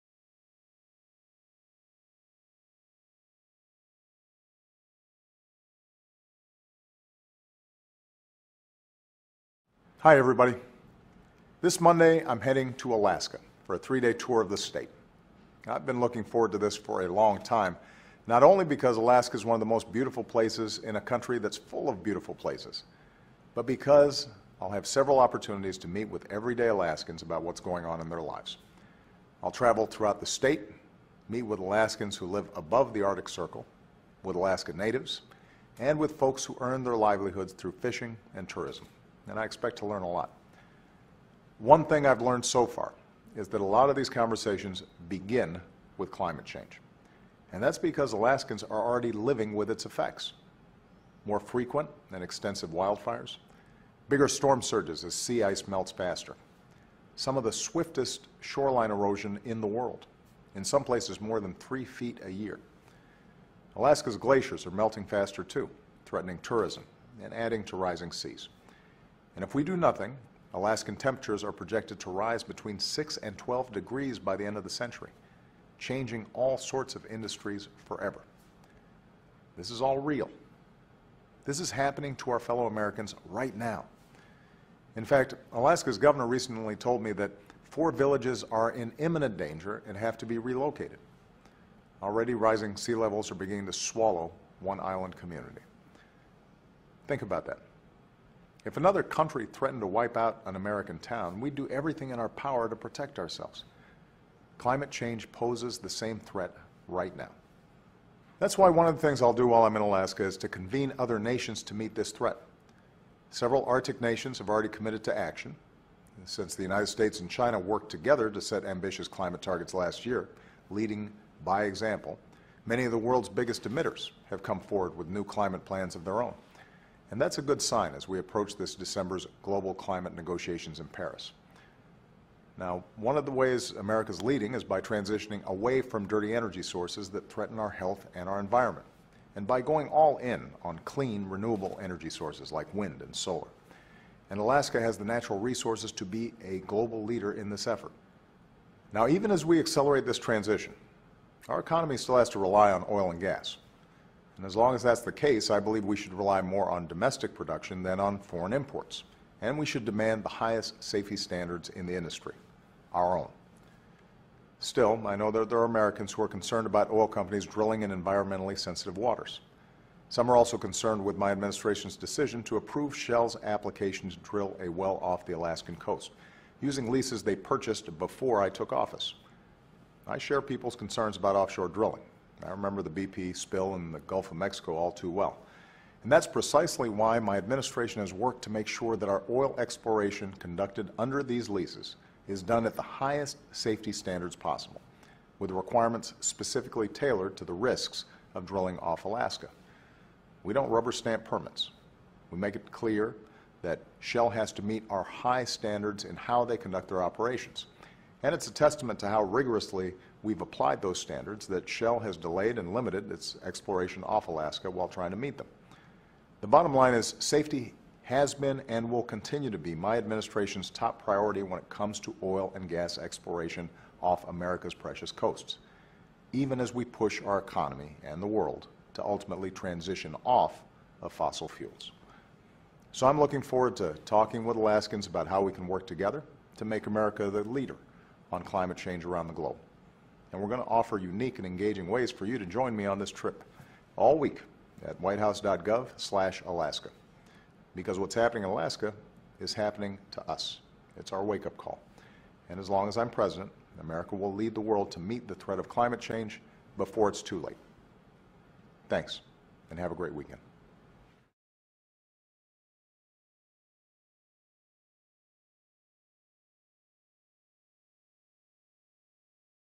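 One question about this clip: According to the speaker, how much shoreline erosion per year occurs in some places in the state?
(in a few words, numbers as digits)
more than 3 feet.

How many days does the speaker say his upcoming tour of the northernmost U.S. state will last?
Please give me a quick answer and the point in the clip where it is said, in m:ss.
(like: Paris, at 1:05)
3, at 0:13.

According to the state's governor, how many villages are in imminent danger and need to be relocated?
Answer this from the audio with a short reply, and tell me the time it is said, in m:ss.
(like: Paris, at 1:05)
4, at 1:27.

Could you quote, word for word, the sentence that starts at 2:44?
Still, I know that there are Americans who are concerned about oil companies drilling in environmentally sensitive waters.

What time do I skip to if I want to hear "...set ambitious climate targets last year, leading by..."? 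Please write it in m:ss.
1:58.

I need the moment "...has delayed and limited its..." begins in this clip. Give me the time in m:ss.
3:31.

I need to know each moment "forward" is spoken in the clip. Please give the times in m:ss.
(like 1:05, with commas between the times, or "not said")
0:16, 2:04, 3:53.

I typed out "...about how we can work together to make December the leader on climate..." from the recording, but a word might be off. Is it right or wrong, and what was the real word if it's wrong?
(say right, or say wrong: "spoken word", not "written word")
wrong: "America", not "December".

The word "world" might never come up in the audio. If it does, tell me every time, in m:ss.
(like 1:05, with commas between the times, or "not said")
0:59, 2:02, 3:48, 4:14.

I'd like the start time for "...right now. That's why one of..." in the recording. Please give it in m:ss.
1:46.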